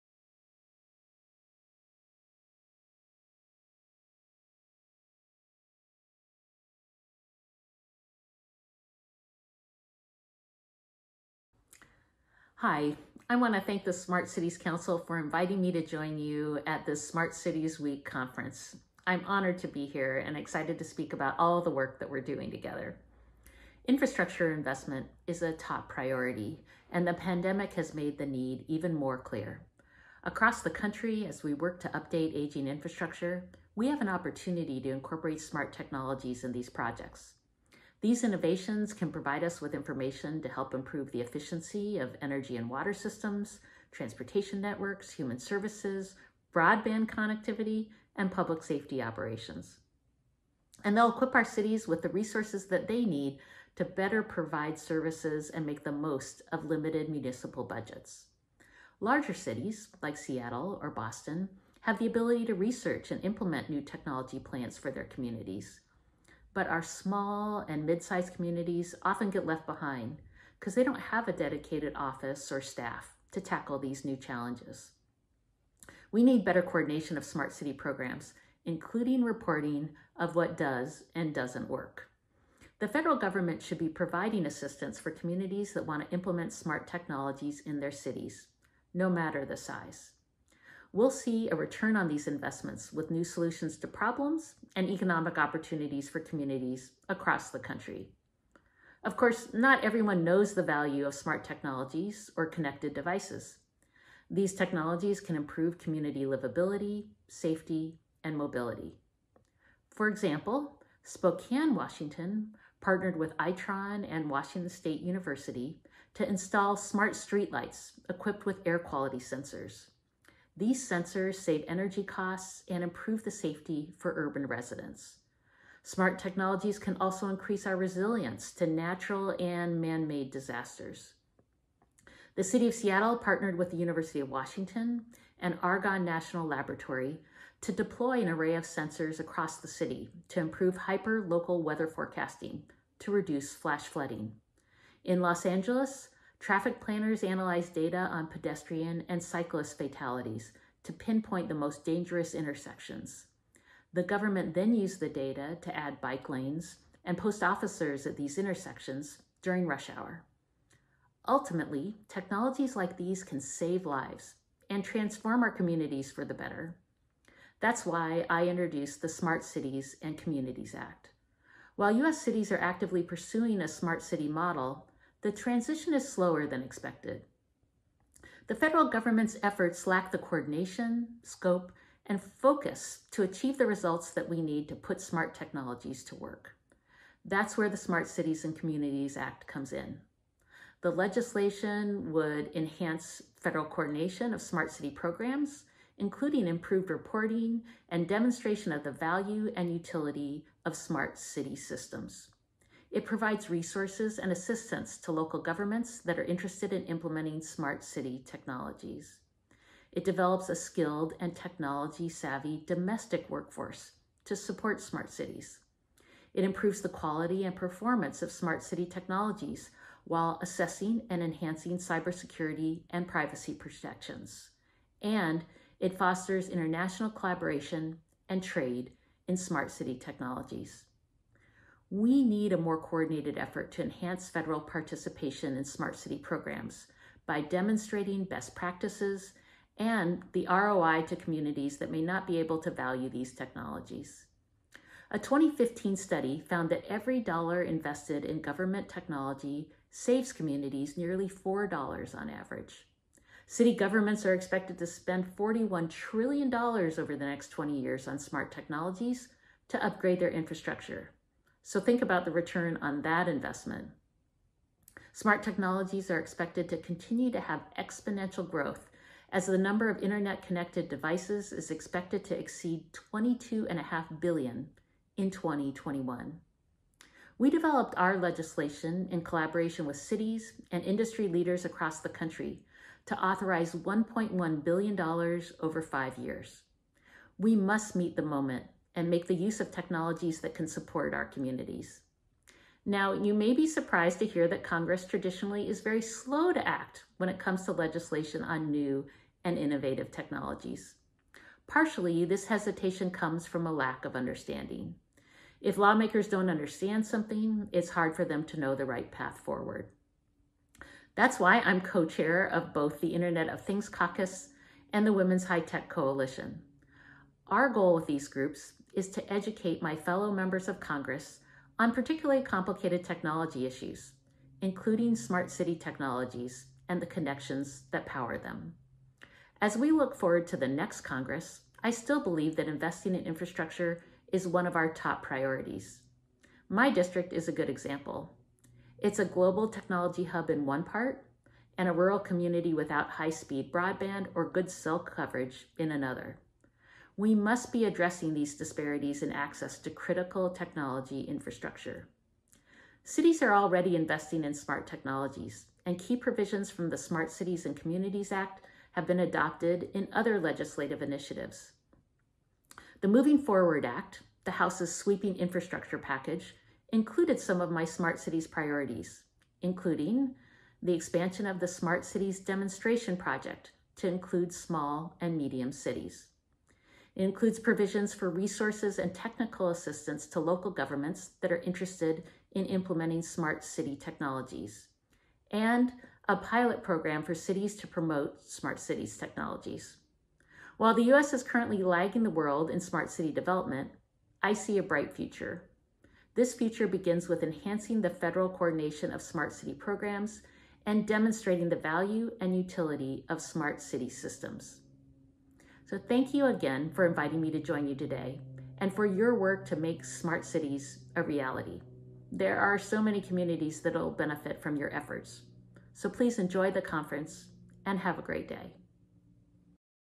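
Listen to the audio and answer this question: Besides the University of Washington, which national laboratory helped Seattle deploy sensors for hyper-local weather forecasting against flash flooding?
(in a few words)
Argonne National Laboratory.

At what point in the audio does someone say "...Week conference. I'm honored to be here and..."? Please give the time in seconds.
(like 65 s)
17 s.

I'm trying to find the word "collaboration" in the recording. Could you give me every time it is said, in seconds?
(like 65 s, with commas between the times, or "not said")
227 s, 279 s.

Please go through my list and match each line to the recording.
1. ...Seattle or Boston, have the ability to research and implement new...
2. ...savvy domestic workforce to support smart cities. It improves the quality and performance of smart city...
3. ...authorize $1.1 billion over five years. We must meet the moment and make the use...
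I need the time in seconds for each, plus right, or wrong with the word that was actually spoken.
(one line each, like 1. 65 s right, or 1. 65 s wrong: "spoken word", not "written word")
1. 60 s right
2. 212 s right
3. 283 s right.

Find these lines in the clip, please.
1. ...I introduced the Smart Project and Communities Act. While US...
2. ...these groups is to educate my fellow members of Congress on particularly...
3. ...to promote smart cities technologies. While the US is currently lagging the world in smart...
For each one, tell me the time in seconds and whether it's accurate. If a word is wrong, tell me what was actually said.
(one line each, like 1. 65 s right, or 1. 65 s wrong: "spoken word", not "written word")
1. 168 s wrong: "Cities", not "Project"
2. 318 s right
3. 387 s right.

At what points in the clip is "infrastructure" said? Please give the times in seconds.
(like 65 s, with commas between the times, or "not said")
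23 s, 32 s, 260 s, 333 s, 351 s, 365 s.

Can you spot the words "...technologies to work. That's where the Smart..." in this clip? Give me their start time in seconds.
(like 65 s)
185 s.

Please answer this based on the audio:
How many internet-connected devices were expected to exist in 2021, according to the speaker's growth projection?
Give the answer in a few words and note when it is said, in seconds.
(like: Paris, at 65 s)
22.5 billion, at 273 s.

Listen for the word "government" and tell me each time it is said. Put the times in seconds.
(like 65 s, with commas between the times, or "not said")
83 s, 154 s, 178 s, 205 s, 248 s, 253 s, 380 s.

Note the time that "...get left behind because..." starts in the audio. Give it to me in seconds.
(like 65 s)
69 s.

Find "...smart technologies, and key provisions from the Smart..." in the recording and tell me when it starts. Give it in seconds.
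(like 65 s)
354 s.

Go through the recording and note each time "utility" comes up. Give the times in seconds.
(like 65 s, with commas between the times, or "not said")
199 s, 402 s.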